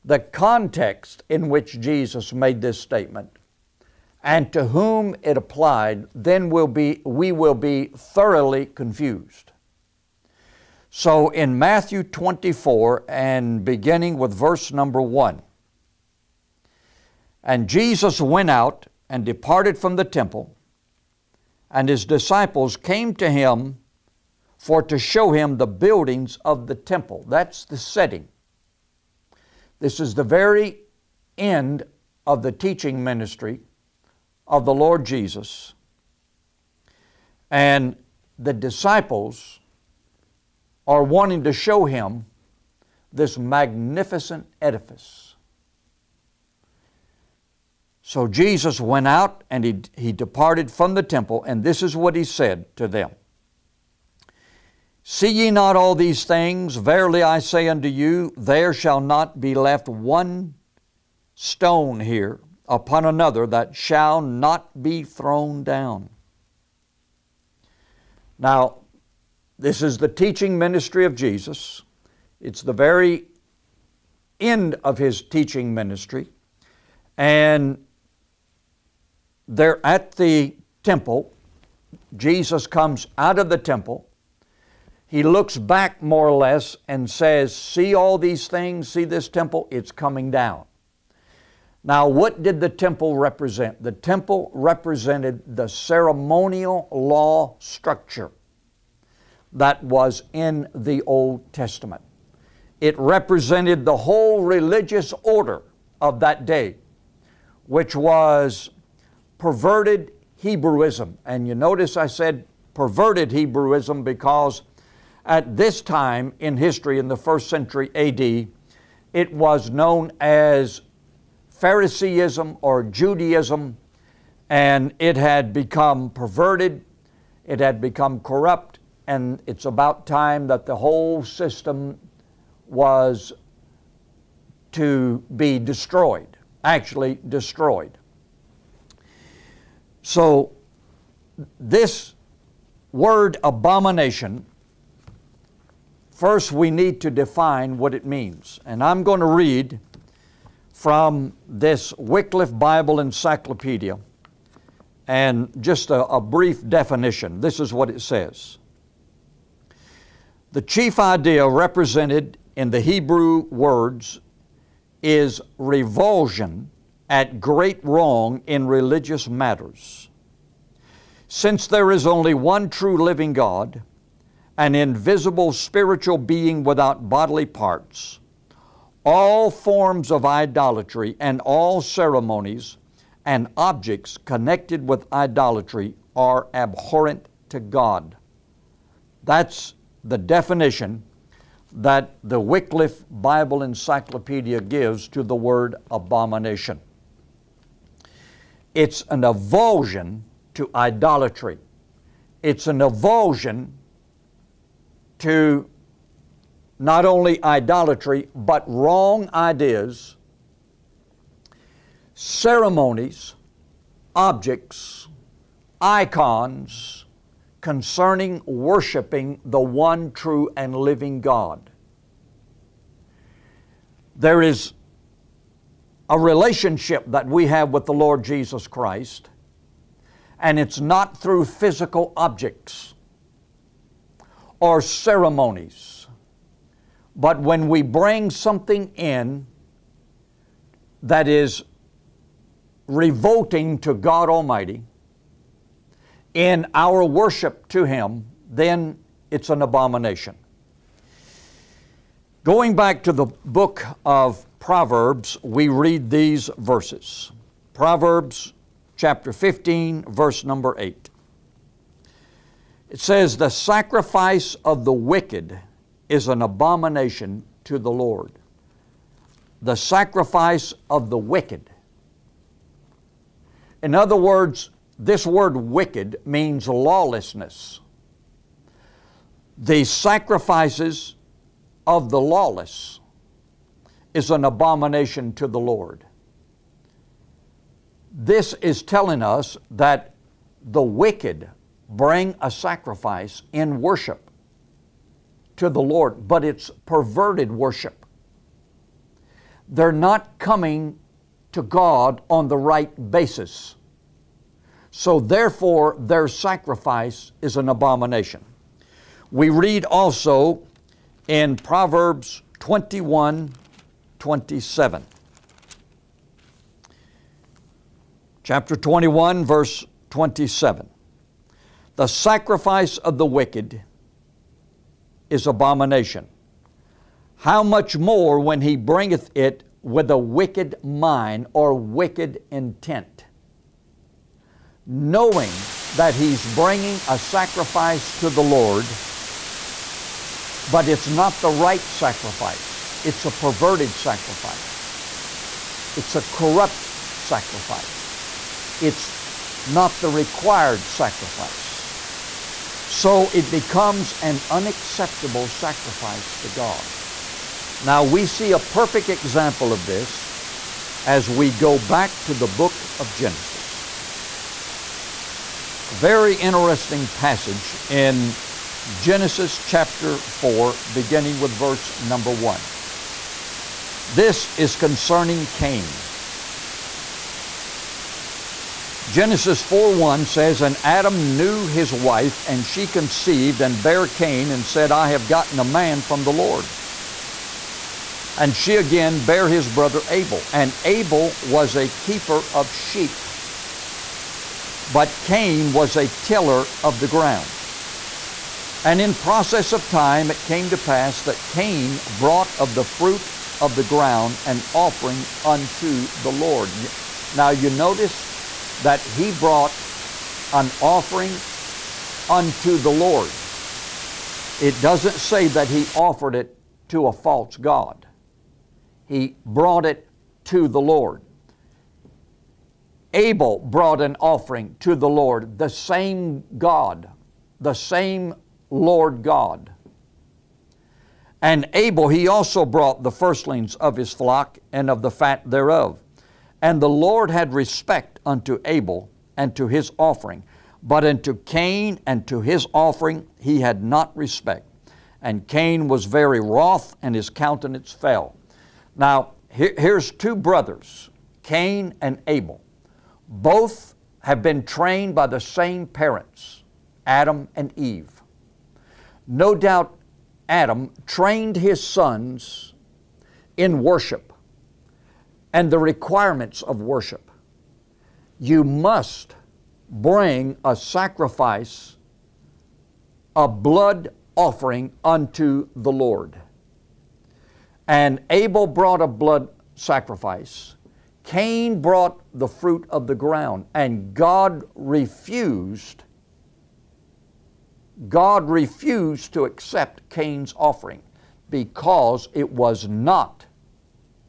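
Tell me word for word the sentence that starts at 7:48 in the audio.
You must bring a sacrifice, a blood offering unto the Lord.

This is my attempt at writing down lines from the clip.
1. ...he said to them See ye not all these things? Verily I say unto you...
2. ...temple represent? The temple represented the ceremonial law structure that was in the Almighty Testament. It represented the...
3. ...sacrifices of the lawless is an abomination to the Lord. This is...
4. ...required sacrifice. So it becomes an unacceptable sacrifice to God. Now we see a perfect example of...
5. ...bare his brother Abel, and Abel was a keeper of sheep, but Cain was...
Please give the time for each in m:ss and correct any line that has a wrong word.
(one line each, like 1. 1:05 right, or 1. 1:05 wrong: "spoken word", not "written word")
1. 0:52 right
2. 1:32 wrong: "Old", not "Almighty"
3. 4:39 right
4. 5:50 right
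5. 6:29 right.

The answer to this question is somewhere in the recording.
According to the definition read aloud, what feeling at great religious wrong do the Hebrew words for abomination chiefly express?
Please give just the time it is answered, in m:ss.
2:45.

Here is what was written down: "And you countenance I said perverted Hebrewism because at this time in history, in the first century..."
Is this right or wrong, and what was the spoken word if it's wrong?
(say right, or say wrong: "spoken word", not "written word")
wrong: "notice", not "countenance".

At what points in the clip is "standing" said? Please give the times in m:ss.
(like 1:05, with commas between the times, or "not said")
not said.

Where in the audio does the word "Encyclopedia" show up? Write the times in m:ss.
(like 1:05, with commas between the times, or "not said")
2:32, 3:13.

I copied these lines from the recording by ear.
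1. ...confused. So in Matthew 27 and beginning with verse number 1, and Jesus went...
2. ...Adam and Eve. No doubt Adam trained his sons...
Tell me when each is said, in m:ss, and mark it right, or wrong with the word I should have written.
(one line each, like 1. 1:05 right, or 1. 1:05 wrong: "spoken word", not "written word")
1. 0:08 wrong: "24", not "27"
2. 7:37 right.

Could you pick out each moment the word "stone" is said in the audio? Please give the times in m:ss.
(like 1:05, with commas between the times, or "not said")
1:01.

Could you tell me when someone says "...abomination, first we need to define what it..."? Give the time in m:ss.
2:23.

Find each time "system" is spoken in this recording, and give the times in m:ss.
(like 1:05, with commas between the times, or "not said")
2:11.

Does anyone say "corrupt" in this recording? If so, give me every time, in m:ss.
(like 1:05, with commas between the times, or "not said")
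2:08, 5:46.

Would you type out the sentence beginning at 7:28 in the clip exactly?
Now, here's two brothers, Cain and Abel.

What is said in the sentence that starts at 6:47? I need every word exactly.
Now you notice that he brought an offering unto the Lord.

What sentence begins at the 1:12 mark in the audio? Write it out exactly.
It's the very end of his teaching ministry.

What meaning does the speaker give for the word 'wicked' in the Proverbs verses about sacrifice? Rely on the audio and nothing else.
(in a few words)
Lawlessness.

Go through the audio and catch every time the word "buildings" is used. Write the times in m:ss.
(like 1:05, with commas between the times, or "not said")
0:25.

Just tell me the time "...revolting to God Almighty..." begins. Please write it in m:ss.
4:02.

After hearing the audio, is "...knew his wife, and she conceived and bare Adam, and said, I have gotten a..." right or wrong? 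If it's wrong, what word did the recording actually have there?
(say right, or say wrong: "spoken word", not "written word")
wrong: "Cain", not "Adam".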